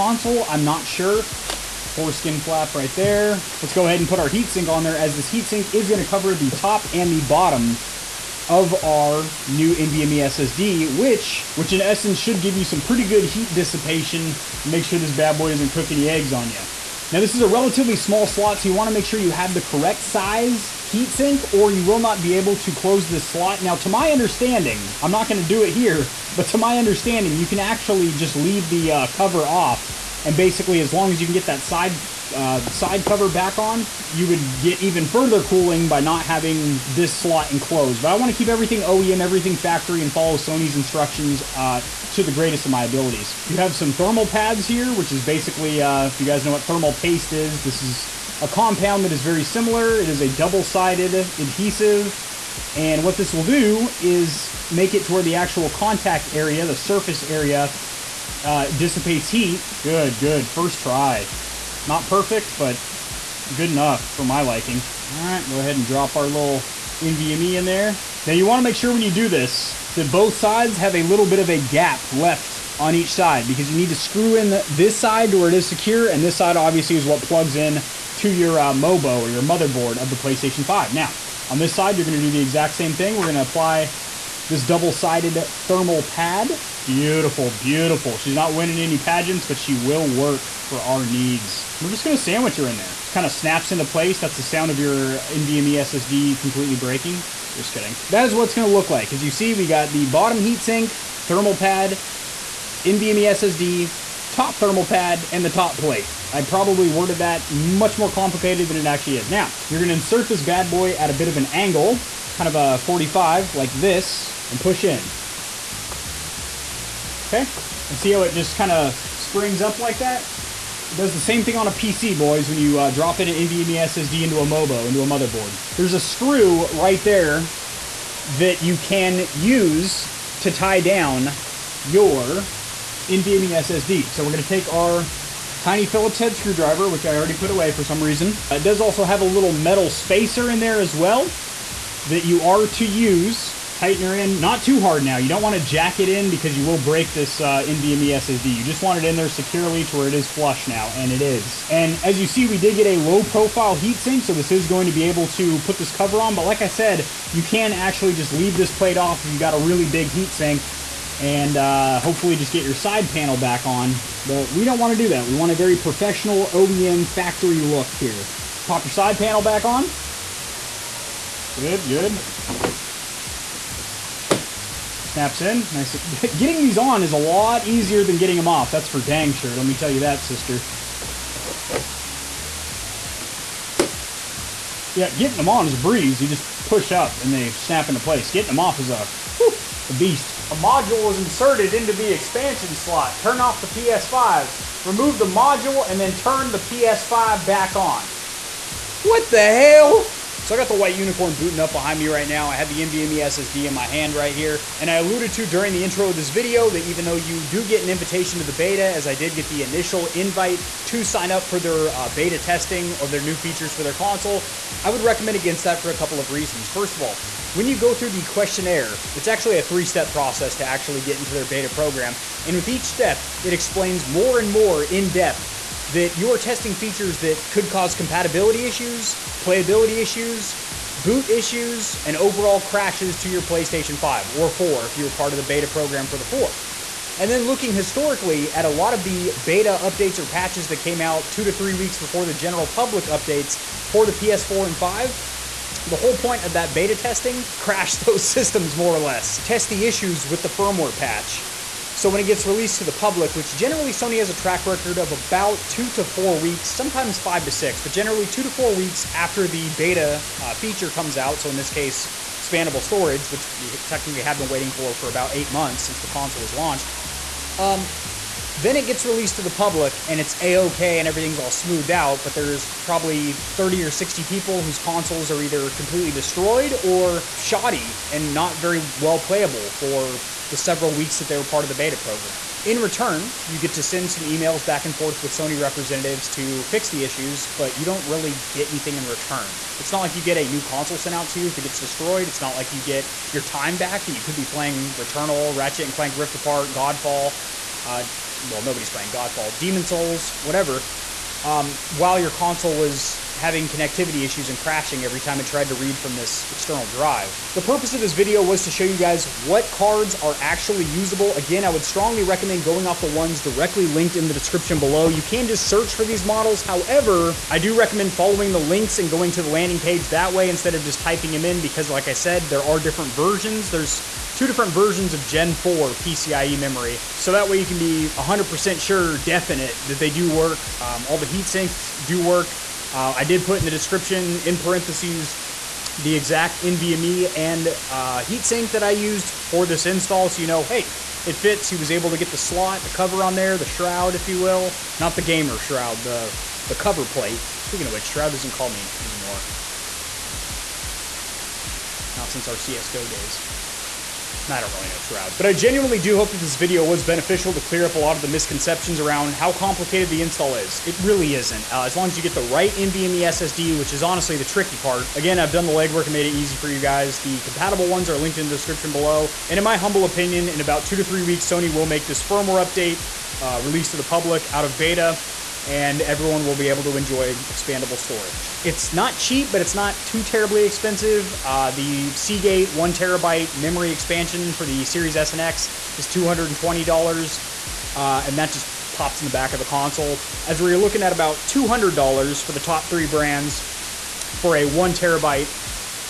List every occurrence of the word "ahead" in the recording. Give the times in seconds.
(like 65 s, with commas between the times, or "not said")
3 s, 65 s.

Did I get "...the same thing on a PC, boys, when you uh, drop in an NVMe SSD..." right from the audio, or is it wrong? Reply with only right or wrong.
right.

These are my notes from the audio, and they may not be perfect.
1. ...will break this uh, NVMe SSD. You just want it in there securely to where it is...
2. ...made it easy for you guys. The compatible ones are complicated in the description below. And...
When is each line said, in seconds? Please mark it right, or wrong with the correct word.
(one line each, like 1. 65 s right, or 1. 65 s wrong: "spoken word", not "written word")
1. 146 s right
2. 366 s wrong: "linked", not "complicated".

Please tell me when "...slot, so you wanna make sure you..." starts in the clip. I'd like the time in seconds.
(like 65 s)
18 s.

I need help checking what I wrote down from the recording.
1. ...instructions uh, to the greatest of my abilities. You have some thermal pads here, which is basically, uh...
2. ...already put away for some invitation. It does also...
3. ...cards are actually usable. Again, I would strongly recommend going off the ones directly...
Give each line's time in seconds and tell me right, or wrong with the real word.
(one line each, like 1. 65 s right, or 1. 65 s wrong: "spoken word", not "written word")
1. 40 s right
2. 137 s wrong: "reason", not "invitation"
3. 309 s right.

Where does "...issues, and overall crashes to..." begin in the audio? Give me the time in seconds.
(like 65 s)
231 s.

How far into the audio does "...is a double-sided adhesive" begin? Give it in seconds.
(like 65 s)
50 s.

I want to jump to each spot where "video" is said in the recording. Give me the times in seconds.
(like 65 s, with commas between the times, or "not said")
206 s, 308 s, 356 s.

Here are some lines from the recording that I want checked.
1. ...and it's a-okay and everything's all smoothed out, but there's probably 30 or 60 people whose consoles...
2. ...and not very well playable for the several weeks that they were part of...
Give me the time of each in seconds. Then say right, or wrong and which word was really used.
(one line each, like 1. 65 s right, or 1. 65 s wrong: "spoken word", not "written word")
1. 270 s right
2. 278 s right.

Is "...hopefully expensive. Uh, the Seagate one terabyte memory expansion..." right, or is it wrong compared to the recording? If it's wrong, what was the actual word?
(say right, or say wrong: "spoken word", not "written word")
wrong: "terribly", not "hopefully".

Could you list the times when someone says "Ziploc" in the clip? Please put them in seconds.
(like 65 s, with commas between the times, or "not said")
not said.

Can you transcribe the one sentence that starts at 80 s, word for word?
Now, on this side, you're gonna do the exact same thing.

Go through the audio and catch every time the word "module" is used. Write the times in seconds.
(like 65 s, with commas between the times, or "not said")
190 s, 195 s.